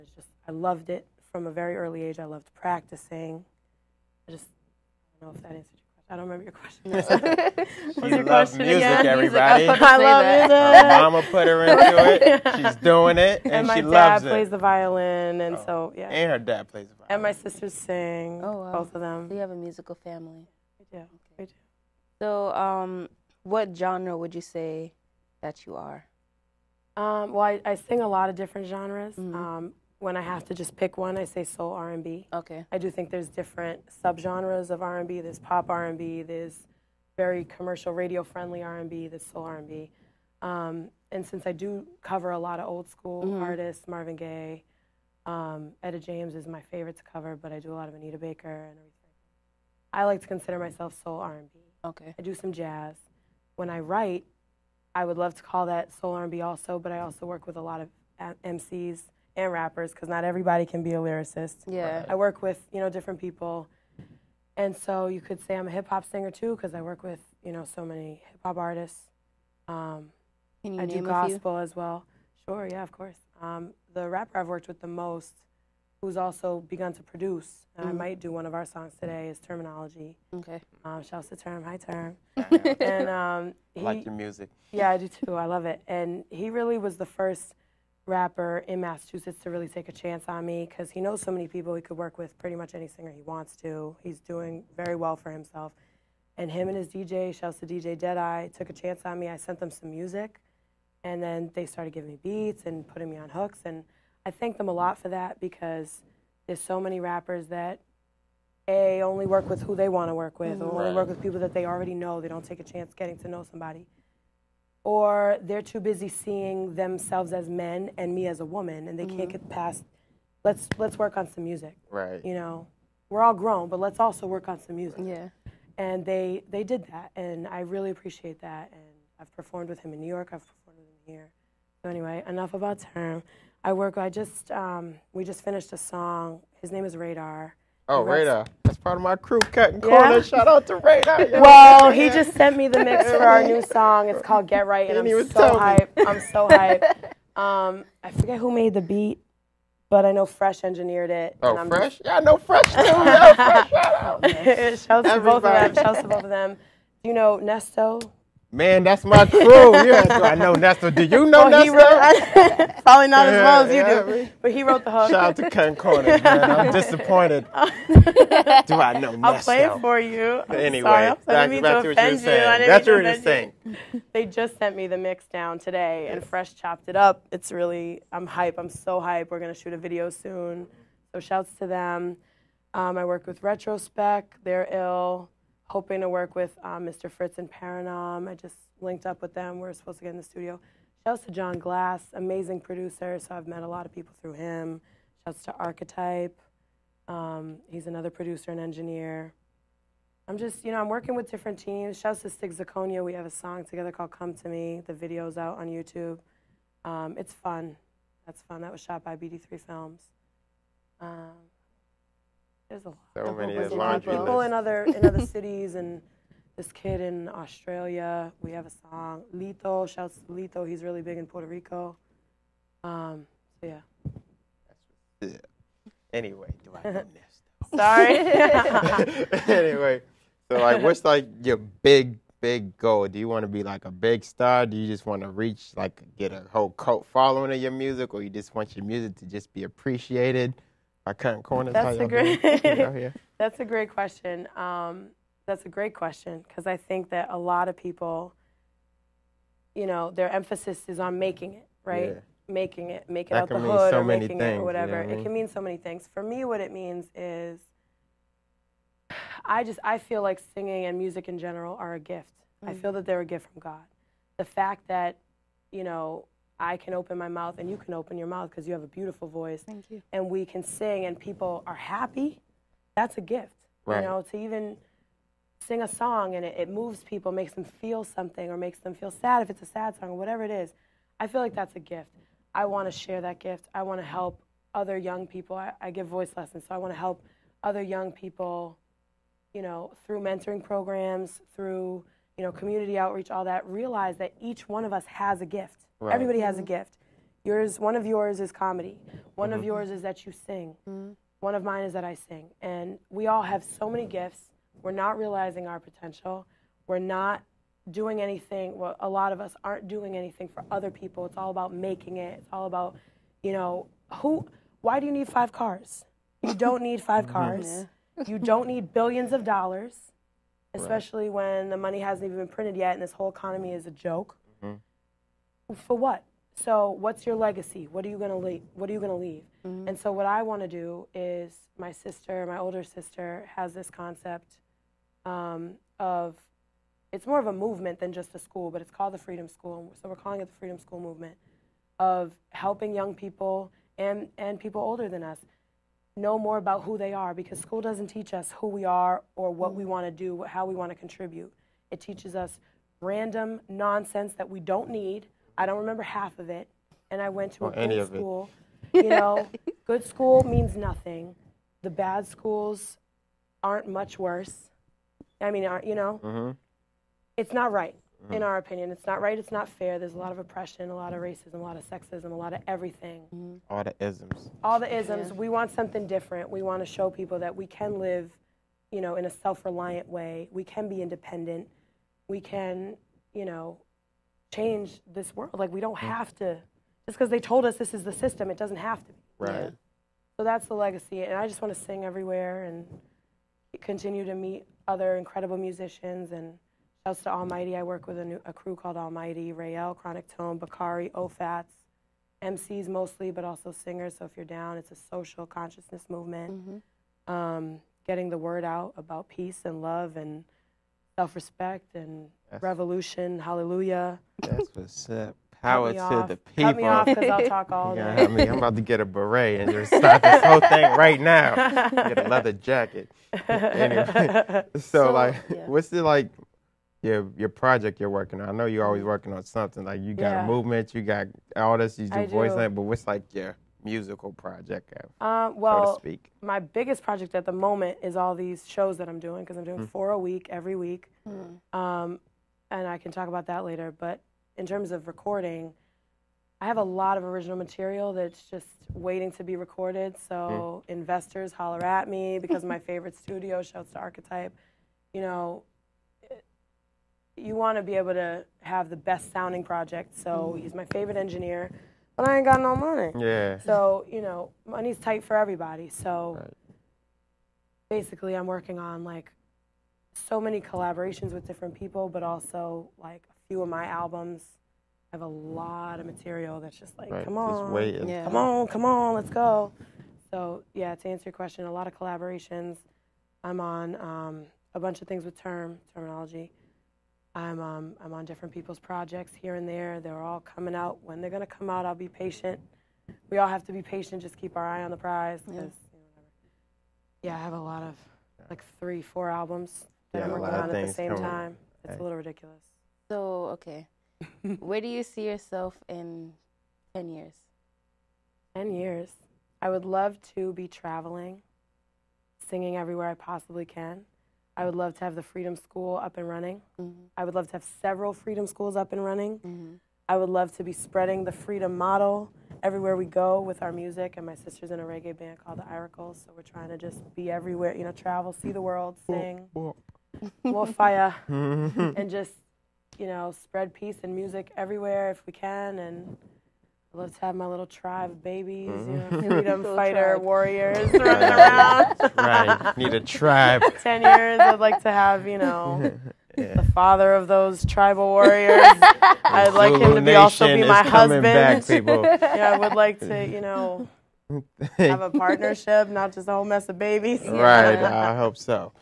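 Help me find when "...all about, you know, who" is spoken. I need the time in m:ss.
5:12.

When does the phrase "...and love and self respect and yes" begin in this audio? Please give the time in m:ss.
6:49.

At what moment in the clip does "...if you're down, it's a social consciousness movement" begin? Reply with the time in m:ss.
6:44.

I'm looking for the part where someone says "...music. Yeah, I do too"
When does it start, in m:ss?
1:24.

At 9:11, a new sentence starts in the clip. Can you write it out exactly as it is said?
Back, yeah, I would like to, you know, have a partnership, not just a whole mess of babies.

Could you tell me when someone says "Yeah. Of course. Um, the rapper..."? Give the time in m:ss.
1:12.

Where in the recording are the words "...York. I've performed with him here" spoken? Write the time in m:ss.
2:10.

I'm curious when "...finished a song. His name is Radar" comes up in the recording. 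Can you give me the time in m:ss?
2:15.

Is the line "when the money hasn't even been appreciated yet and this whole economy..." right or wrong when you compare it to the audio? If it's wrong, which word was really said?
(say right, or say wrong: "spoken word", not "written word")
wrong: "printed", not "appreciated".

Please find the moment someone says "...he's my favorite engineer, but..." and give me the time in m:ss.
7:40.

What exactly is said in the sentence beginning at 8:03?
I'm on um, a bunch of things with Term Terminology.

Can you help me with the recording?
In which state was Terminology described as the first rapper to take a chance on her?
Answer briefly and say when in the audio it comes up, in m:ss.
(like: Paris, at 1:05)
Massachusetts, at 1:28.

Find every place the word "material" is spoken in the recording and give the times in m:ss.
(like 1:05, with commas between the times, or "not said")
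7:27, 7:56.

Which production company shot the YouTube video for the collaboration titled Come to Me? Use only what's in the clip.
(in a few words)
BD3 Films.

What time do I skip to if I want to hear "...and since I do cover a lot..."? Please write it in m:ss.
0:41.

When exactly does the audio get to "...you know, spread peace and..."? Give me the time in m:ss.
8:52.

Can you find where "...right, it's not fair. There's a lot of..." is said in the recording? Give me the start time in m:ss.
6:09.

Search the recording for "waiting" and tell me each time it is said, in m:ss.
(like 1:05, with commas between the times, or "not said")
7:28.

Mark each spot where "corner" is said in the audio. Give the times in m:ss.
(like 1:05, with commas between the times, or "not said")
2:19, 2:45, 4:01.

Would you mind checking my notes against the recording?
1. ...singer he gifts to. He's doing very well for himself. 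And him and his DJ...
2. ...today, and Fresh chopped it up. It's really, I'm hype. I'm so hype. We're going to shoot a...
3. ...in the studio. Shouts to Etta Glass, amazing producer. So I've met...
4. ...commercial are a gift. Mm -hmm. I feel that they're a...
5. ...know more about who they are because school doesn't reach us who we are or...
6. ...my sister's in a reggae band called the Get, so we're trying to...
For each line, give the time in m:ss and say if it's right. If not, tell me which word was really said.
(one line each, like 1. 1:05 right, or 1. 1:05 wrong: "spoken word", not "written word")
1. 1:32 wrong: "wants", not "gifts"
2. 2:55 right
3. 3:10 wrong: "John", not "Etta"
4. 4:21 wrong: "general", not "commercial"
5. 5:46 wrong: "teach", not "reach"
6. 8:44 wrong: "Iracles", not "Get".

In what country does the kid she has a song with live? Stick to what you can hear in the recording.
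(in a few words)
Australia.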